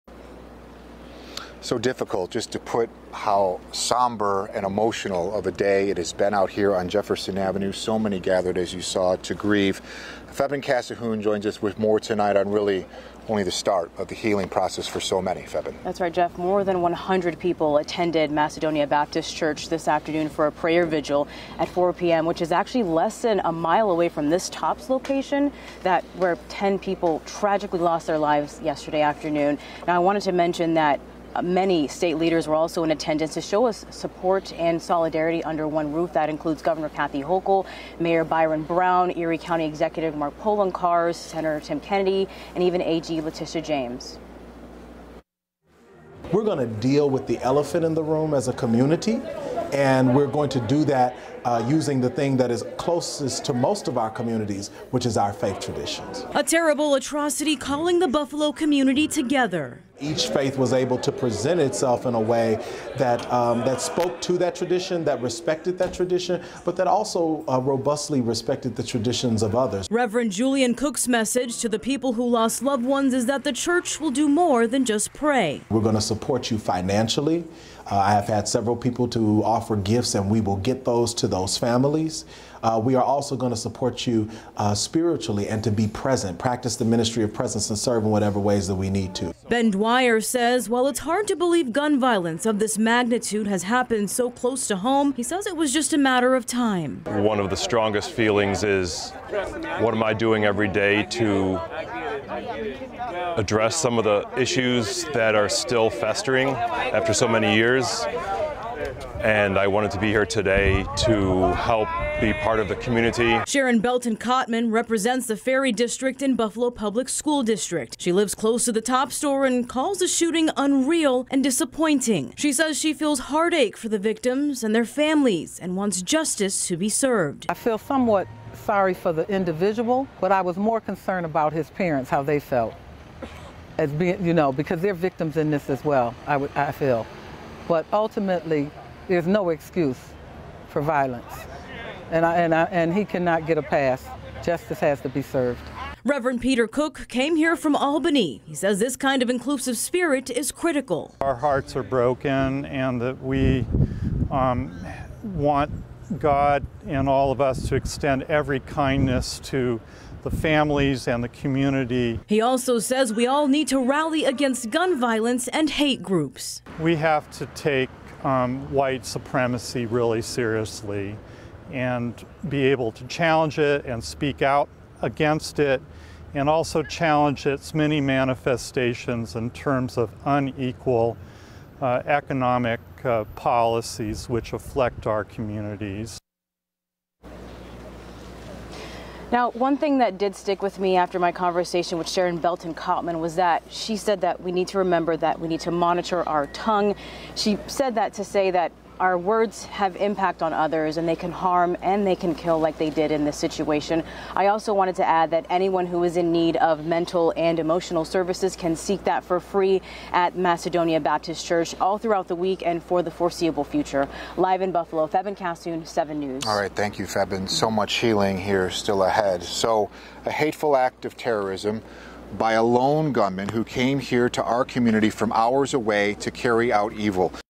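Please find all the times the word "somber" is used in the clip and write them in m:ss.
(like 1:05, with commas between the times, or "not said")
0:03.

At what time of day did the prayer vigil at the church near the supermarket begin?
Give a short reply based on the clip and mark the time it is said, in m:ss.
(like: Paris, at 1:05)
4 p.m., at 0:21.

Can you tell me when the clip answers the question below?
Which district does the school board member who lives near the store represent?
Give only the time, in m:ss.
1:55.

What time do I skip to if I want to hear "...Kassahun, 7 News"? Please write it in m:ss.
3:35.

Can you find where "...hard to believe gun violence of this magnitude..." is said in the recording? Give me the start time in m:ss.
1:30.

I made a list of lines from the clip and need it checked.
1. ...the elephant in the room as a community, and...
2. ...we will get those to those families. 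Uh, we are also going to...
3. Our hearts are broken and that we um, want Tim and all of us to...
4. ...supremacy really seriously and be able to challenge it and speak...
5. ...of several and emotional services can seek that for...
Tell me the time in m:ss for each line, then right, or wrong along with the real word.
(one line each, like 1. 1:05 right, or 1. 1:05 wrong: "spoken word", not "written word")
1. 0:47 right
2. 1:20 right
3. 2:31 wrong: "God", not "Tim"
4. 2:49 right
5. 3:26 wrong: "mental", not "several".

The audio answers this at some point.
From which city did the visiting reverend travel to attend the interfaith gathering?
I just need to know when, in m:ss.
2:27.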